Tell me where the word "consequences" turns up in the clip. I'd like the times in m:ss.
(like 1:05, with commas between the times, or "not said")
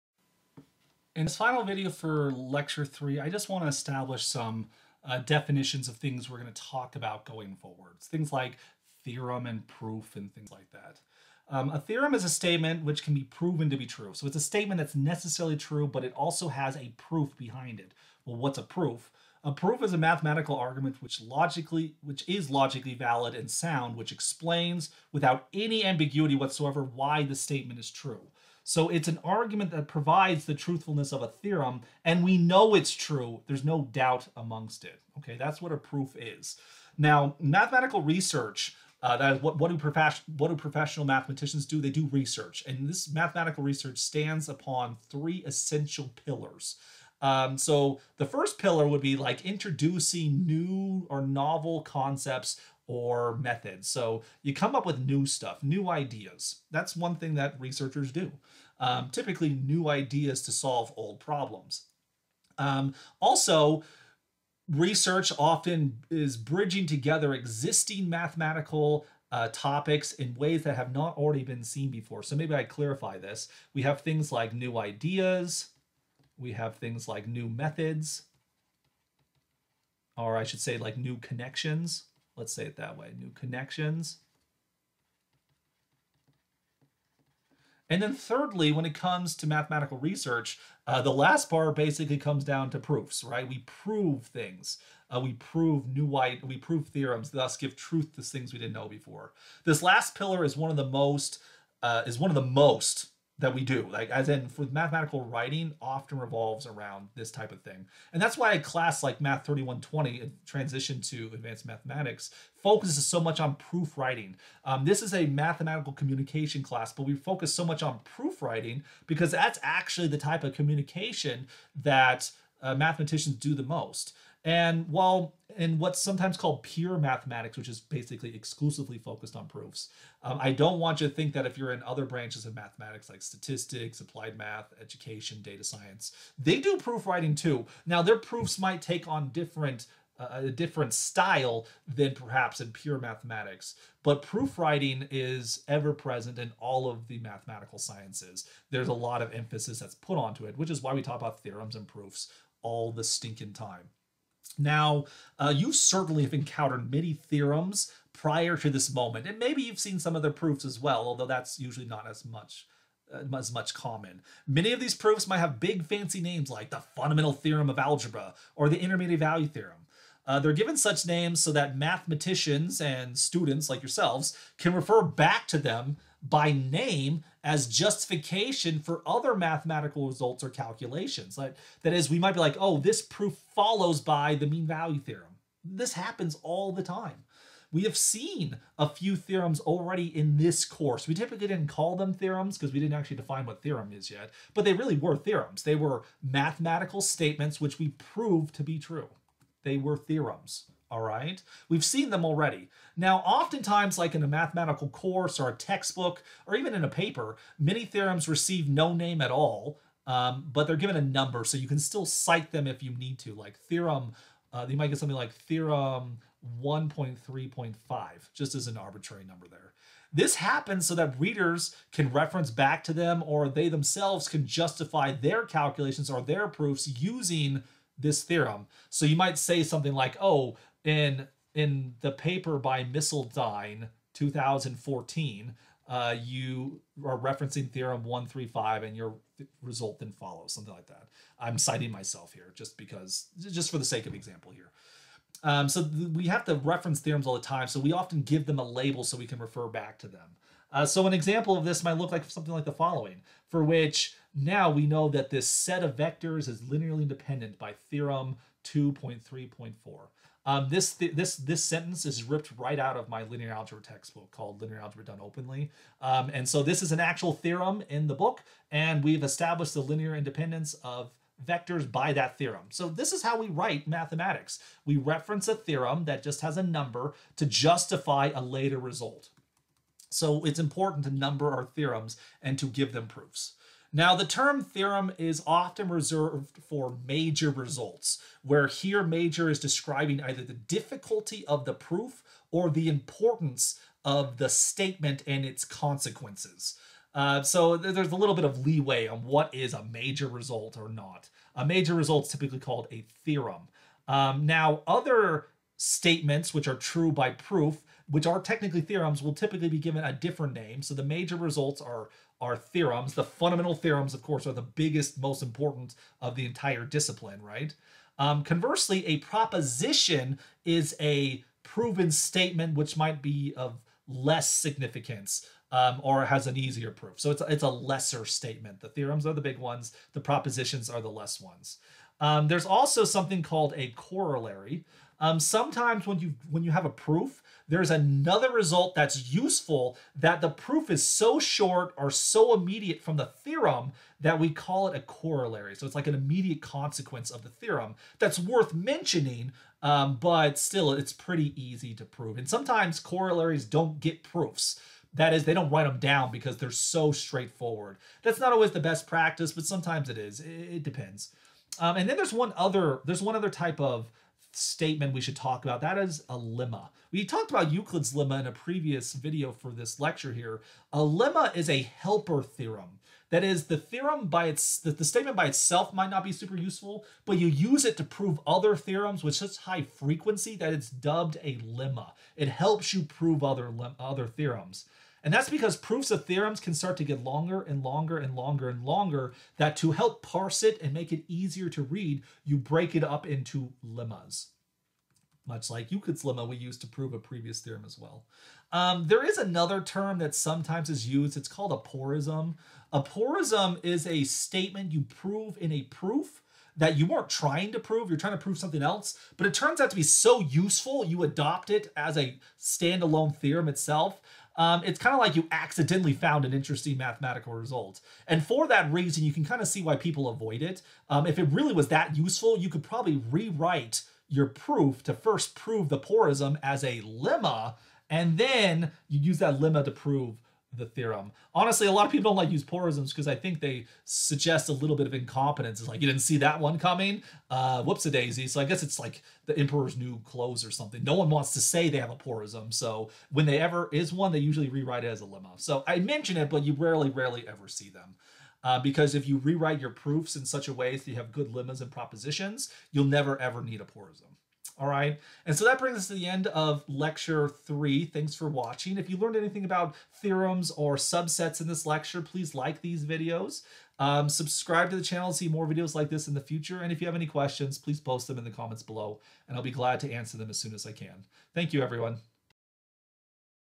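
4:55, 5:46.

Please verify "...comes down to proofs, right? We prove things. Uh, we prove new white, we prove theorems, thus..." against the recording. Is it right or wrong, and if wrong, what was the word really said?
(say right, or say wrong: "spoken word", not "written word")
right.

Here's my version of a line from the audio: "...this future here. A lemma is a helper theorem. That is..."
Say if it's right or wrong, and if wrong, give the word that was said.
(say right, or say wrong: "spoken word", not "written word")
wrong: "lecture", not "future".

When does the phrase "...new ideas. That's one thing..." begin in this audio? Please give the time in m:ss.
0:55.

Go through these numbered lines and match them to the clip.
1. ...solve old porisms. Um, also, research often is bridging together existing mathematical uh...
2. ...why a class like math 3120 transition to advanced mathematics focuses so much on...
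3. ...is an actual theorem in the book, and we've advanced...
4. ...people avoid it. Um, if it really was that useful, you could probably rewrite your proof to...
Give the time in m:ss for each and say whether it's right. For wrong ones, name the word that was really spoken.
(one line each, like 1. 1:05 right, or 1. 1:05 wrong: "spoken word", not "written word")
1. 1:00 wrong: "problems", not "porisms"
2. 1:48 right
3. 4:26 wrong: "established", not "advanced"
4. 6:59 right.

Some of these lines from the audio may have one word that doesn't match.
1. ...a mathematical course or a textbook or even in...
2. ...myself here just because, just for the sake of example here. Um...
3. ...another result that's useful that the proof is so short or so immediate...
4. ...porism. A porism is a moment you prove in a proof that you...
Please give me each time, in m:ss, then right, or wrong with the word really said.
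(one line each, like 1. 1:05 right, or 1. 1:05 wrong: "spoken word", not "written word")
1. 3:24 right
2. 4:01 right
3. 5:37 right
4. 6:41 wrong: "statement", not "moment".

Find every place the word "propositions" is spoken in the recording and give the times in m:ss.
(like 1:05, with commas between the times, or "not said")
5:19, 5:30, 7:31.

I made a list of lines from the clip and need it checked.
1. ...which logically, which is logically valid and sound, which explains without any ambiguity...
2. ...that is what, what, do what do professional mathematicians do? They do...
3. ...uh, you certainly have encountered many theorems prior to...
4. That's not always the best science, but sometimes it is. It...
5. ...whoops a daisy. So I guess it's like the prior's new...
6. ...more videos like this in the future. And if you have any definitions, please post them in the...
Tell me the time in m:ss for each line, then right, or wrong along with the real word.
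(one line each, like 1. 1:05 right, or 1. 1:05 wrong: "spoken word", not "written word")
1. 0:21 right
2. 0:39 right
3. 2:35 right
4. 5:58 wrong: "practice", not "science"
5. 7:17 wrong: "emperor", not "prior"
6. 7:45 wrong: "questions", not "definitions".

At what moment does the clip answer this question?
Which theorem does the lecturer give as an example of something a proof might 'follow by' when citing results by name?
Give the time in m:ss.
3:04.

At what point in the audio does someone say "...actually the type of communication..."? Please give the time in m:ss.
1:59.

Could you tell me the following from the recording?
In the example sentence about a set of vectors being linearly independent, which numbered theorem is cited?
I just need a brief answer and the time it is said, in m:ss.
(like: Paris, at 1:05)
Theorem 2.3.4, at 4:17.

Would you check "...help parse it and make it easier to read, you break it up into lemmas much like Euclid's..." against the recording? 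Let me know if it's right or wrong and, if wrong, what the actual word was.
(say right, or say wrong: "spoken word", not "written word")
right.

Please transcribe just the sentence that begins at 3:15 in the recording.
They were mathematical statements which we proved to be true.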